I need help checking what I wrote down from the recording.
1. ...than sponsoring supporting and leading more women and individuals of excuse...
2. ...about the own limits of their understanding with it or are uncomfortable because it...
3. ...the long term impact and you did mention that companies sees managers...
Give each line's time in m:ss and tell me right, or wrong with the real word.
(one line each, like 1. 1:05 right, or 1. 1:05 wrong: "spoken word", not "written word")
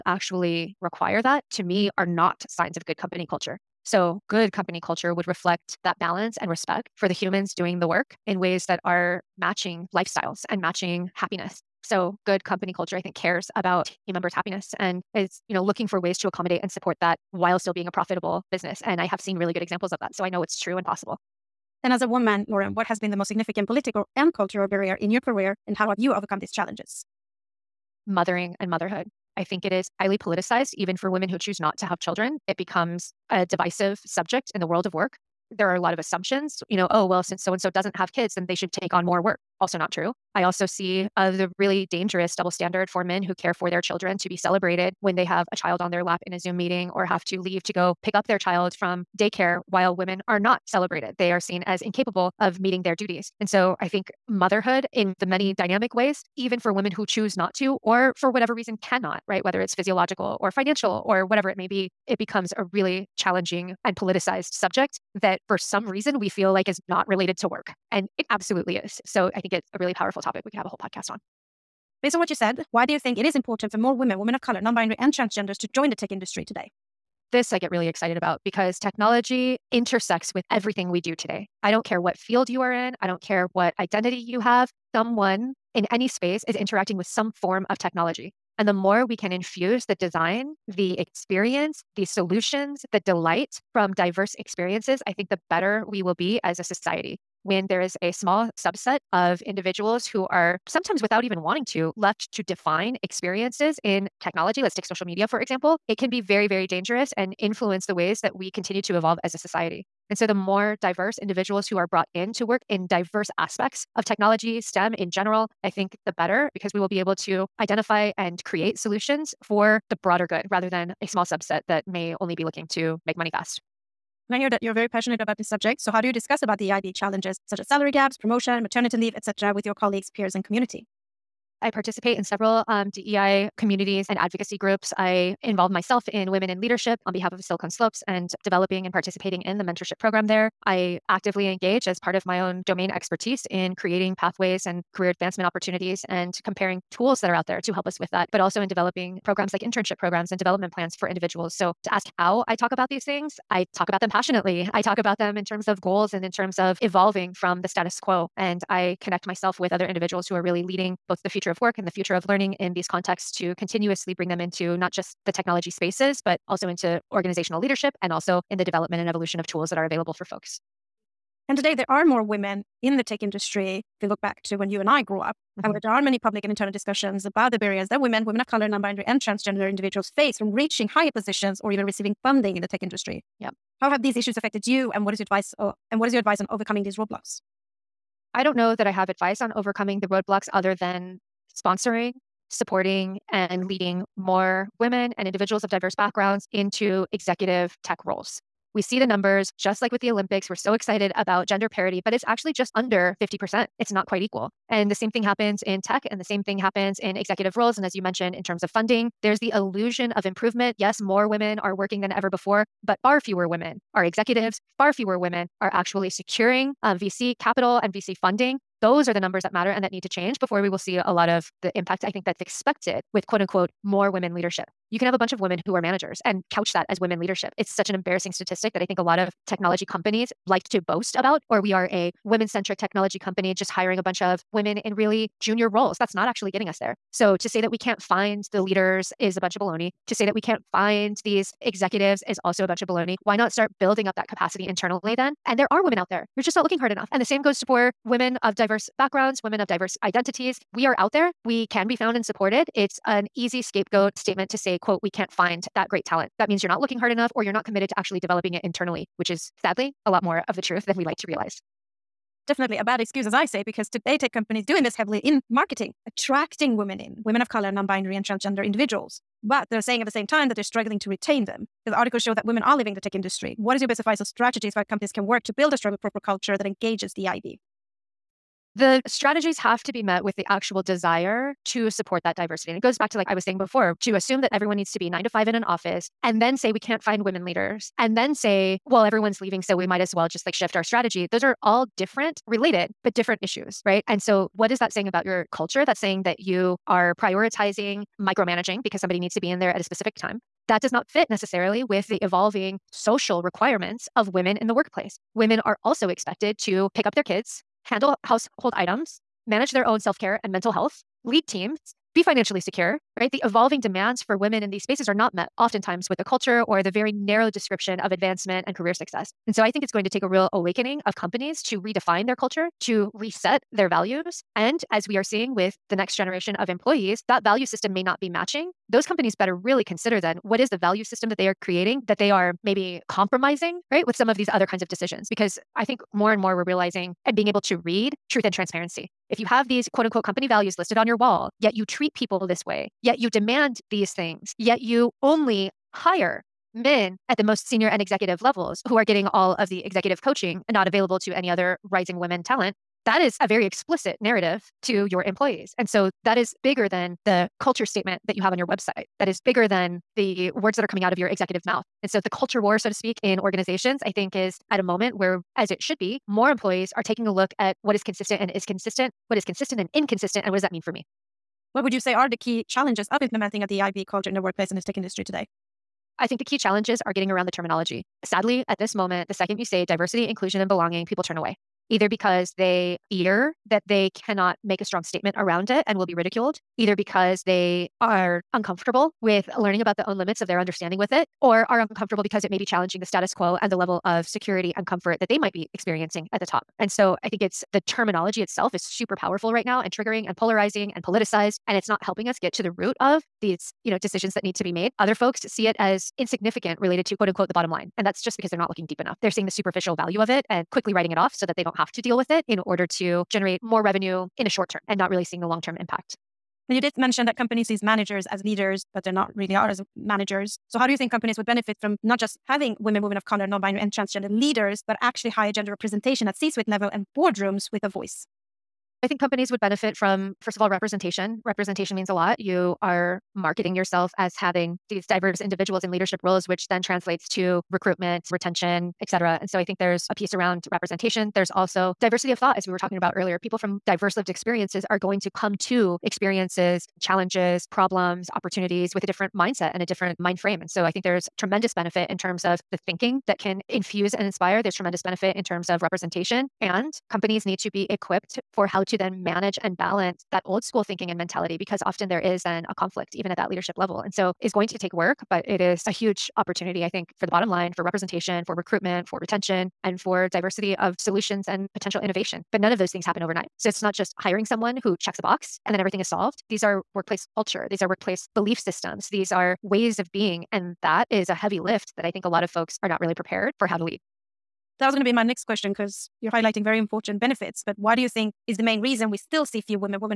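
1. 3:10 wrong: "diverse", not "excuse"
2. 6:29 right
3. 6:55 right.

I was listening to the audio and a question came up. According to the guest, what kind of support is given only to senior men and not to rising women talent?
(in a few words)
Executive coaching.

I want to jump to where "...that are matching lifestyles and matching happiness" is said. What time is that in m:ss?
0:08.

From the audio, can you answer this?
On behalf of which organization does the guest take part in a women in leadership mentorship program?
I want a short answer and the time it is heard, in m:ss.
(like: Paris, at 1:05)
Silicon Slopes, at 2:17.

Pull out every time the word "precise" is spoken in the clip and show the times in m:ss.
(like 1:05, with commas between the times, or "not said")
not said.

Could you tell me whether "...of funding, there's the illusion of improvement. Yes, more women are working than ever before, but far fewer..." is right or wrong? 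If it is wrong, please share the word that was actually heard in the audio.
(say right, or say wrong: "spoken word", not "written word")
right.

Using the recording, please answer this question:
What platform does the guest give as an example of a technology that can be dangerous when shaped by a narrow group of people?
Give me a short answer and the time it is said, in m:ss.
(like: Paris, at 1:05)
Social media, at 1:44.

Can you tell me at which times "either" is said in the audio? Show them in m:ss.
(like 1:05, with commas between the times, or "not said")
6:21, 6:26.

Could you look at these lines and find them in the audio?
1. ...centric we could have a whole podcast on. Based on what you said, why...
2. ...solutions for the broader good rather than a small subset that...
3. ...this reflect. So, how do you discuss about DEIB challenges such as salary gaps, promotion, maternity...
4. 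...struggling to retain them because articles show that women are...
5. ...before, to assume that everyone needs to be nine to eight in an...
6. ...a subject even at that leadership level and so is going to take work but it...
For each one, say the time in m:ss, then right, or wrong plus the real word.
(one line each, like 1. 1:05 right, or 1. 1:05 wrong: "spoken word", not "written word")
1. 1:10 wrong: "topic", not "centric"
2. 1:58 right
3. 2:05 wrong: "subject", not "reflect"
4. 4:30 right
5. 4:43 wrong: "five", not "eight"
6. 7:42 wrong: "conflict", not "subject".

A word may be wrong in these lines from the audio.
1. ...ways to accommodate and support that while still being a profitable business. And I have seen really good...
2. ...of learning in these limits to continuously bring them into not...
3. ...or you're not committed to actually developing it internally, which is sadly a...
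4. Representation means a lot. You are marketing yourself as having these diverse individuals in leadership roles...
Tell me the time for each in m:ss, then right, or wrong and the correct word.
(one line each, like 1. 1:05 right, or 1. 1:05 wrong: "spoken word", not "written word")
1. 0:15 right
2. 2:42 wrong: "contexts", not "limits"
3. 4:17 right
4. 7:11 right.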